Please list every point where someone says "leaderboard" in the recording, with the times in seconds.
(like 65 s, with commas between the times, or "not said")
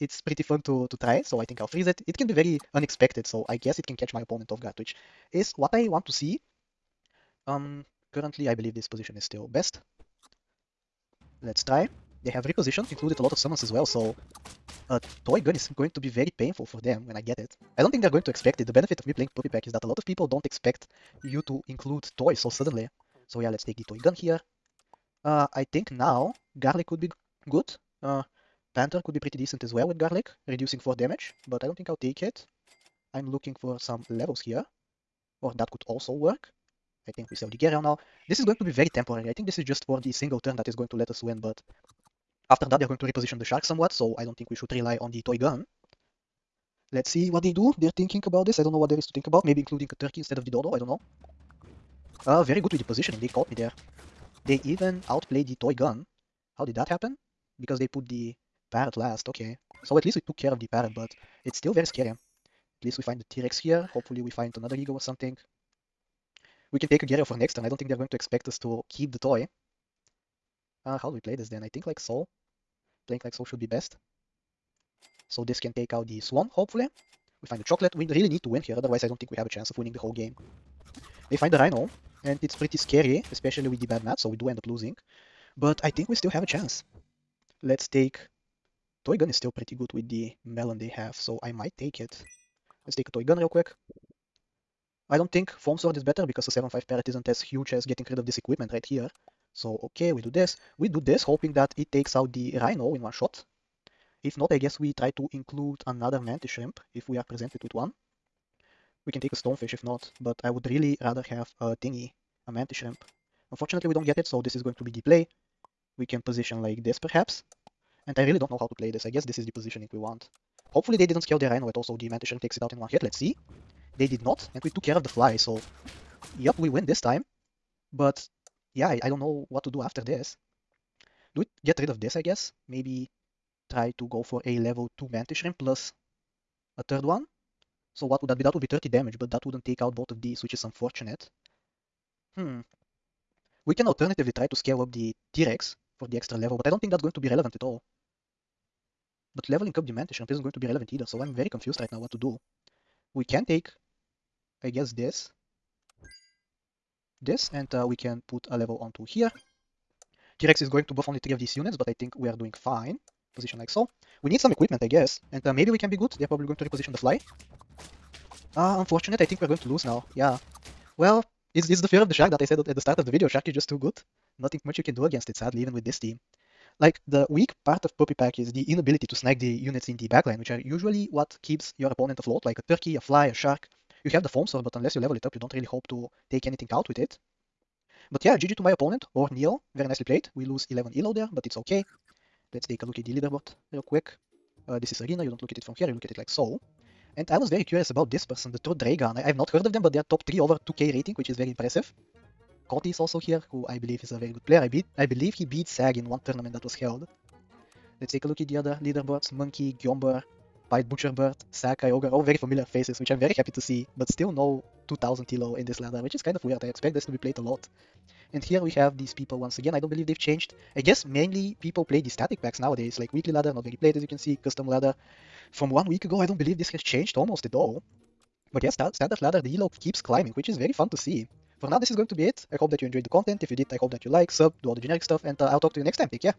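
193 s, 208 s.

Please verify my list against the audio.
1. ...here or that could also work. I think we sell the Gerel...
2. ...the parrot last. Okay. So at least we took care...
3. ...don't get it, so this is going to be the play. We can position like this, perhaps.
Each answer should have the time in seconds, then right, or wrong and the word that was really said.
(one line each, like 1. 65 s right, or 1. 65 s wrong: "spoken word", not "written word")
1. 34 s right
2. 58 s right
3. 113 s right.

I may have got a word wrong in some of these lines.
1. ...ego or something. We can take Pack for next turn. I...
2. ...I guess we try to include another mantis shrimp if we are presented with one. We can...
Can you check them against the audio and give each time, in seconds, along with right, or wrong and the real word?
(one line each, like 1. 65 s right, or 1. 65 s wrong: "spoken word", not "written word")
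1. 64 s wrong: "Agario", not "Pack"
2. 104 s right.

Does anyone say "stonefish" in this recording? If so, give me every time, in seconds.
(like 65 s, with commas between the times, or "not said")
109 s.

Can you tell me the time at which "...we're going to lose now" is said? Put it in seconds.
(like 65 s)
169 s.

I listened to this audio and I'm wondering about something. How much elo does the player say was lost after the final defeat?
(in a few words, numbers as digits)
11.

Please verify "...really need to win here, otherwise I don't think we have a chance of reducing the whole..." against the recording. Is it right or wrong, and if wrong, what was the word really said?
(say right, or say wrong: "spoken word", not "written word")
wrong: "winning", not "reducing".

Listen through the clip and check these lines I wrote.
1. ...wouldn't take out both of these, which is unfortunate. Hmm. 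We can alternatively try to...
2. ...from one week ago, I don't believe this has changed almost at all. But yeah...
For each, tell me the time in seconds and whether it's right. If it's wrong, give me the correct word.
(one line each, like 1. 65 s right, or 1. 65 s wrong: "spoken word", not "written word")
1. 139 s right
2. 225 s right.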